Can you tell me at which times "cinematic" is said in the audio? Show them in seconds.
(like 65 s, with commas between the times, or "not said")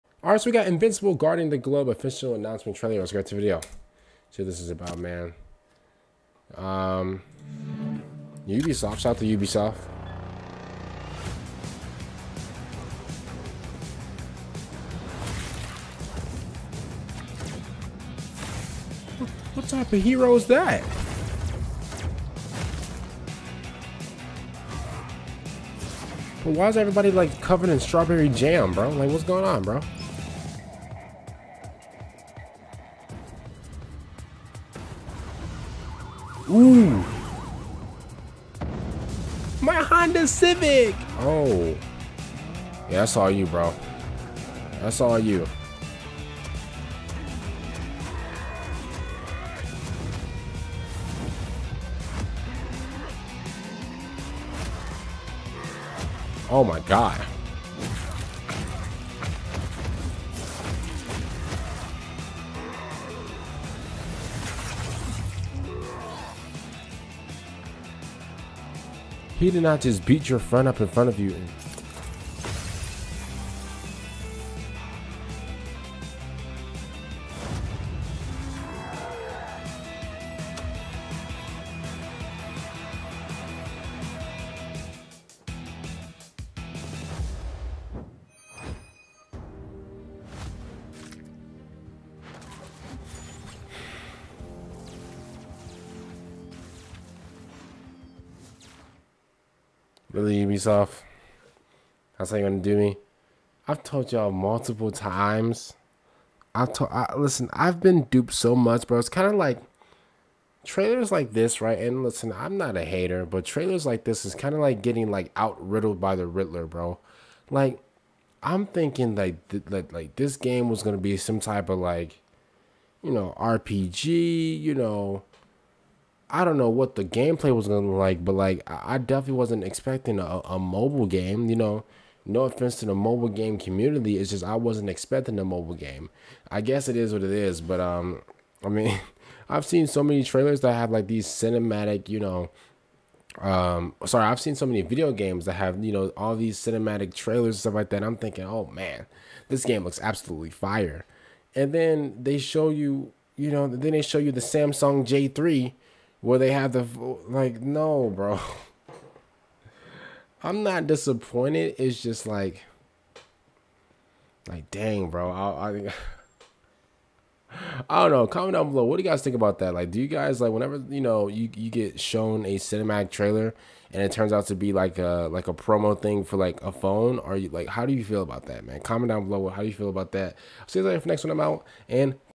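141 s, 146 s, 172 s.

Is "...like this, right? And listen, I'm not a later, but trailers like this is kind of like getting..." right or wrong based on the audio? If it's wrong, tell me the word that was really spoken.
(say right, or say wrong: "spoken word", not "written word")
wrong: "hater", not "later".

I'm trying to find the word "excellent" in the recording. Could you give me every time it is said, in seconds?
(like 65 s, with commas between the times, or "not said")
not said.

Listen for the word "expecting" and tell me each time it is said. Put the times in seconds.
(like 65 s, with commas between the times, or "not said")
129 s, 134 s.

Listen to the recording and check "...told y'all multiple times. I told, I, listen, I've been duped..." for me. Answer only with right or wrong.
right.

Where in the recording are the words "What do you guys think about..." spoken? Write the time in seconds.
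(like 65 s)
168 s.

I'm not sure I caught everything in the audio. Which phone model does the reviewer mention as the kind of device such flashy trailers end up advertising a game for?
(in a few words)
Samsung J3.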